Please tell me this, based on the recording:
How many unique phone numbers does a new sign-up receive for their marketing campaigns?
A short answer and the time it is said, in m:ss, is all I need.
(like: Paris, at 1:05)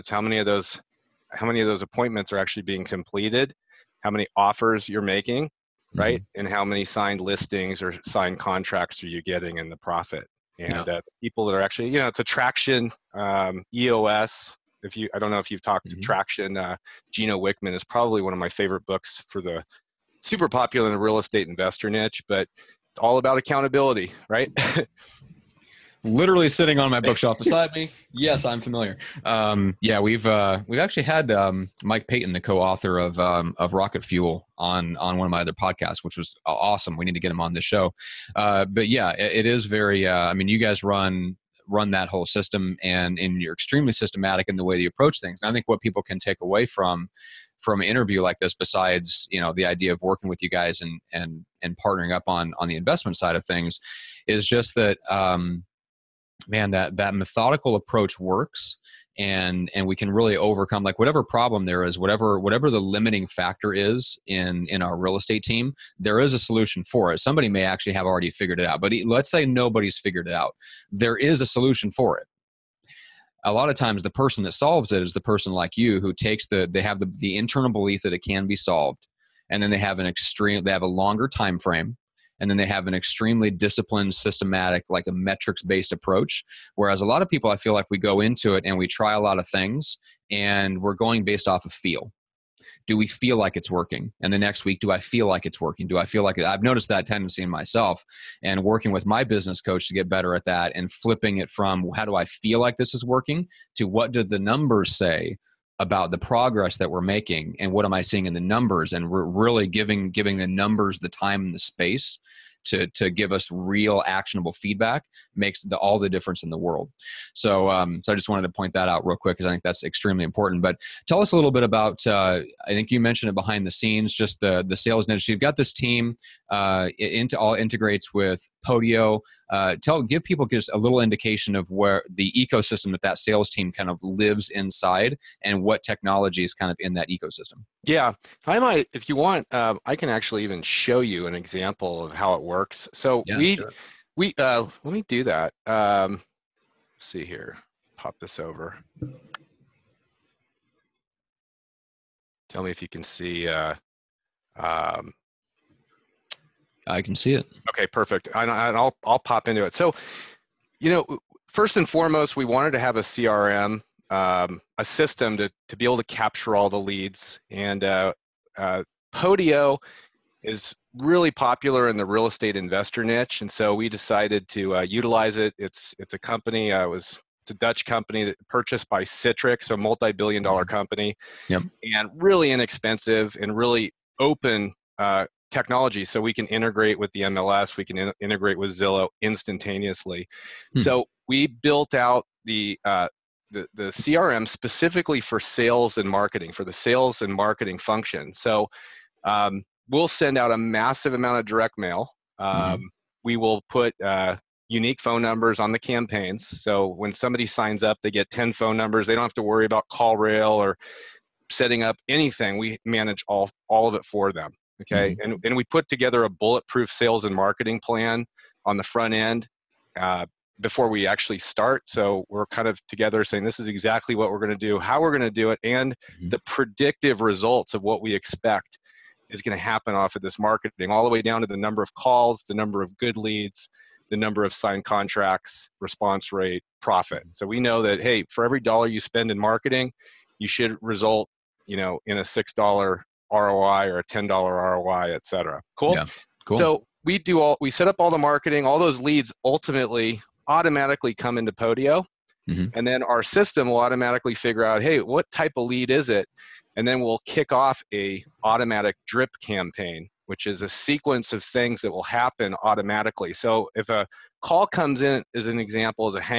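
10, at 3:28.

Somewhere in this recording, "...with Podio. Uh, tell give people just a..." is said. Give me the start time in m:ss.
2:08.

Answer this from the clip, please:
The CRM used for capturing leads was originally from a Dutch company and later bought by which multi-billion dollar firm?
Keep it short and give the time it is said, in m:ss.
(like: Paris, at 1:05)
Citrix, at 2:59.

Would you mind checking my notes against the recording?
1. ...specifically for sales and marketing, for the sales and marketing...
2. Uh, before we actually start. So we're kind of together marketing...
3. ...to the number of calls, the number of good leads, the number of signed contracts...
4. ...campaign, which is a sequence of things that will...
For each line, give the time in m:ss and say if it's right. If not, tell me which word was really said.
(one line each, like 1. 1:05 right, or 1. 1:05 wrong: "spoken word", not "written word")
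1. 3:14 right
2. 3:39 wrong: "saying", not "marketing"
3. 3:51 right
4. 4:19 right.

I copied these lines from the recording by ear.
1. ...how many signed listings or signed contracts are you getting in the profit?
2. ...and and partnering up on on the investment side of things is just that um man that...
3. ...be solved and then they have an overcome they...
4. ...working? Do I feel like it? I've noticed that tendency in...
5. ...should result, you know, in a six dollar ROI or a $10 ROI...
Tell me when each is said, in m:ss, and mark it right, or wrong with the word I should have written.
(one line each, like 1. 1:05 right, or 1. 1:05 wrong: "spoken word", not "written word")
1. 0:06 right
2. 0:51 right
3. 1:18 wrong: "extreme", not "overcome"
4. 1:35 right
5. 4:00 right.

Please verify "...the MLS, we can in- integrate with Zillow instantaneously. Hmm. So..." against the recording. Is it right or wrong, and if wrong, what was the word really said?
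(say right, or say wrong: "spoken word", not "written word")
right.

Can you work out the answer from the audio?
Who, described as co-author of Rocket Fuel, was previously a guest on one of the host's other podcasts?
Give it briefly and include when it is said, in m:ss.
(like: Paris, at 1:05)
Mike Paton, at 0:31.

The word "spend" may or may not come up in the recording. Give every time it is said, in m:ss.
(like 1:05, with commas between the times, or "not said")
3:59.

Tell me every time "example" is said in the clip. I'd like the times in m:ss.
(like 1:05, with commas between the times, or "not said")
2:21, 4:25.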